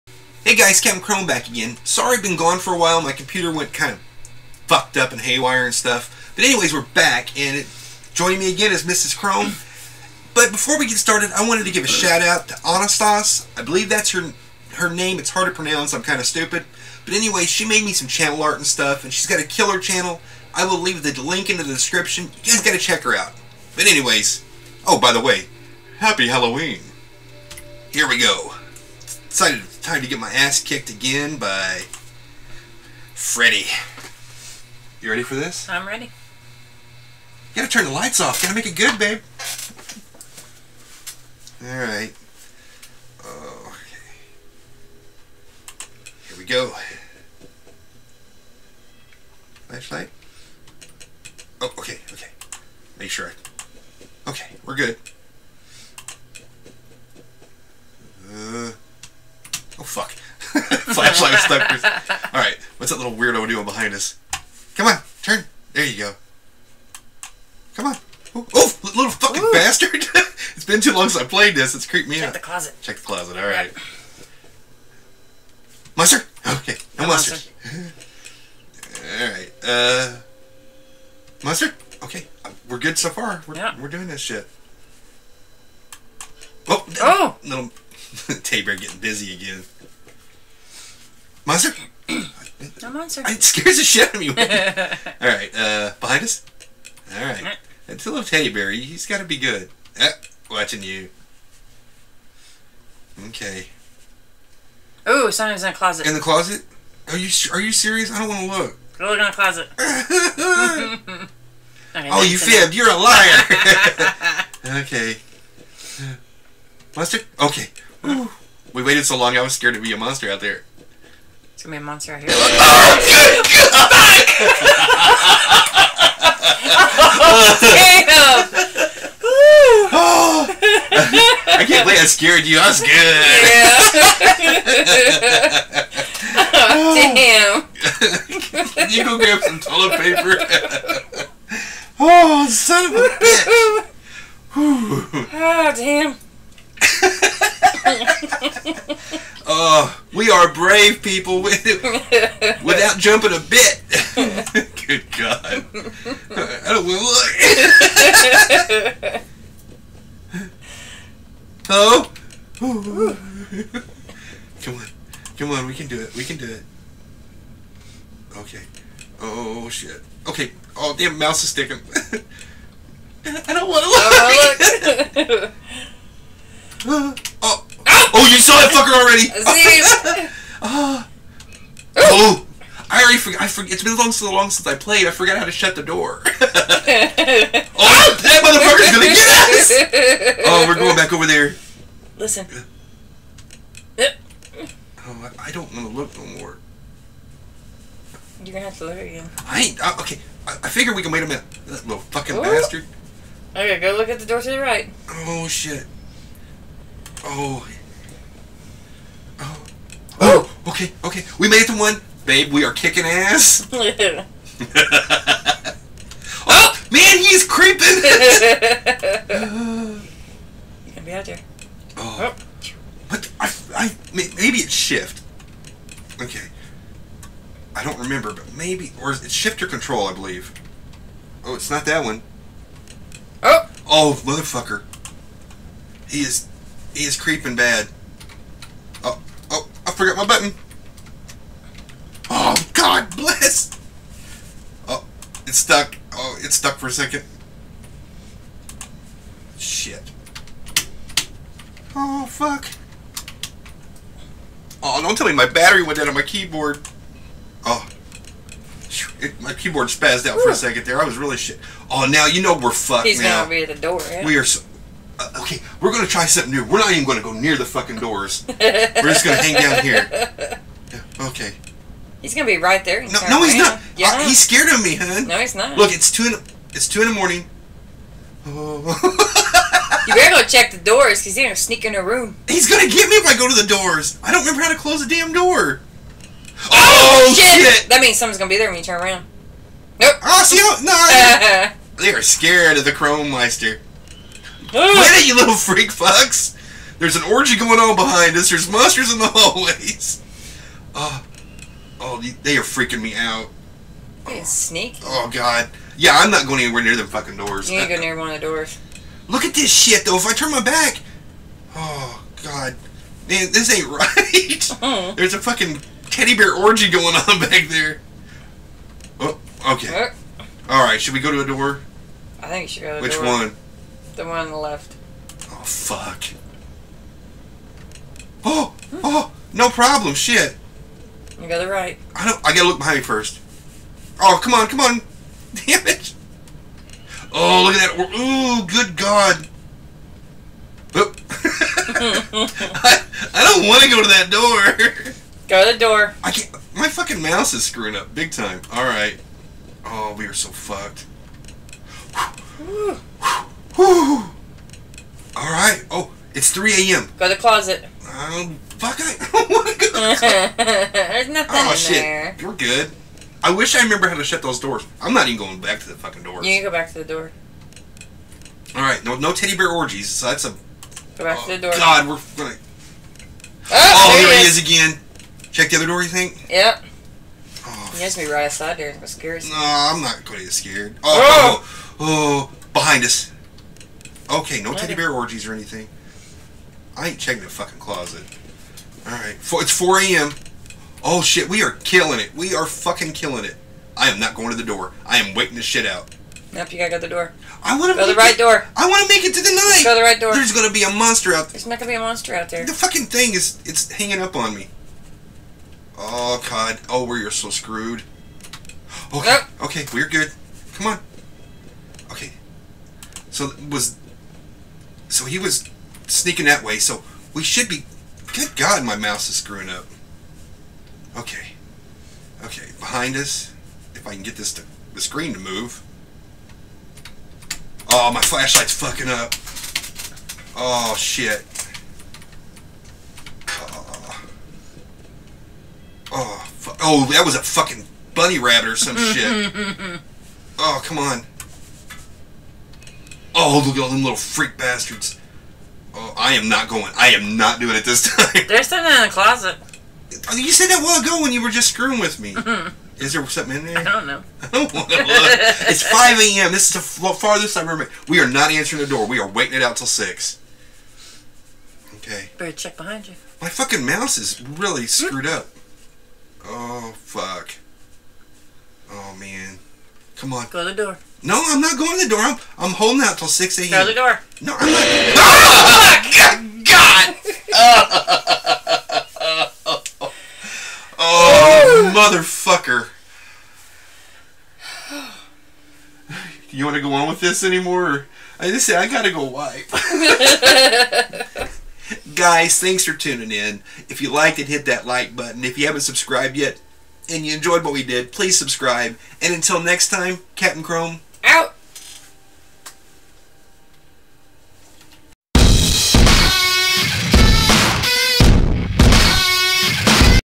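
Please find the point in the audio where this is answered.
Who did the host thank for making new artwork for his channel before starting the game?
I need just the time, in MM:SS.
00:12.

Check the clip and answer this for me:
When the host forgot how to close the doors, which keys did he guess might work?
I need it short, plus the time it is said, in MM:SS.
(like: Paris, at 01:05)
Shift or control, at 03:49.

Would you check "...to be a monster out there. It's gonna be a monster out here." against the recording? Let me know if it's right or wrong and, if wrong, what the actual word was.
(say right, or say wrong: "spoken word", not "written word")
right.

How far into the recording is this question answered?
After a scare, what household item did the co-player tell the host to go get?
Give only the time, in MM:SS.
02:19.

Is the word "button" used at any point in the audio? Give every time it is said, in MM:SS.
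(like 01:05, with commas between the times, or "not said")
04:00, 08:15.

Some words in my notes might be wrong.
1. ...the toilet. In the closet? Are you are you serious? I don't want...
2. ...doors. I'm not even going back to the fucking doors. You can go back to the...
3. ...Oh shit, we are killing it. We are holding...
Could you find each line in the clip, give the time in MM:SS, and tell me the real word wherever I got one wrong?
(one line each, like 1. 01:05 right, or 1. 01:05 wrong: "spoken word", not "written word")
1. 01:45 wrong: "closet", not "toilet"
2. 06:04 right
3. 06:31 wrong: "fucking", not "holding".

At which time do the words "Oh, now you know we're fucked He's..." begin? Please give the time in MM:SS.
04:21.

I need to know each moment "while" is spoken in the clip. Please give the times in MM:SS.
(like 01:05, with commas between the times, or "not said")
00:02, 07:30.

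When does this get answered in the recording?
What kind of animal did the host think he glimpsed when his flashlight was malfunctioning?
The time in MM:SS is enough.
07:18.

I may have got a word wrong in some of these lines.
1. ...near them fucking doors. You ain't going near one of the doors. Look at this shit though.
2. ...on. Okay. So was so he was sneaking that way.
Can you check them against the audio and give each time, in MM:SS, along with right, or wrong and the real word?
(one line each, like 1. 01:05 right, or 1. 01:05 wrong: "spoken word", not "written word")
1. 05:06 right
2. 06:50 right.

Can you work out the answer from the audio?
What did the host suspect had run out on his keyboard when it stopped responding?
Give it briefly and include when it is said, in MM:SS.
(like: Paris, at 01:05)
Battery, at 04:15.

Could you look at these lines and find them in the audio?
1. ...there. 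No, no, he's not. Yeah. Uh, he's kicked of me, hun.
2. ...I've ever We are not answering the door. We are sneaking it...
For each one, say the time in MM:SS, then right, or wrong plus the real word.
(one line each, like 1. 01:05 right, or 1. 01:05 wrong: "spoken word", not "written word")
1. 04:32 wrong: "scared", not "kicked"
2. 07:37 wrong: "waiting", not "sneaking".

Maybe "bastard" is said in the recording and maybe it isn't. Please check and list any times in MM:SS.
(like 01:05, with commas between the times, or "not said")
01:09, 03:22, 07:24.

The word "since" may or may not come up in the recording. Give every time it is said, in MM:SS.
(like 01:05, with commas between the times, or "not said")
01:11, 03:04.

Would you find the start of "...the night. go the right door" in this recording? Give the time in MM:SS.
06:39.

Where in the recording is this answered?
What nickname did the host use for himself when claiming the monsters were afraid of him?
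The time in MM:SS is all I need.
04:52.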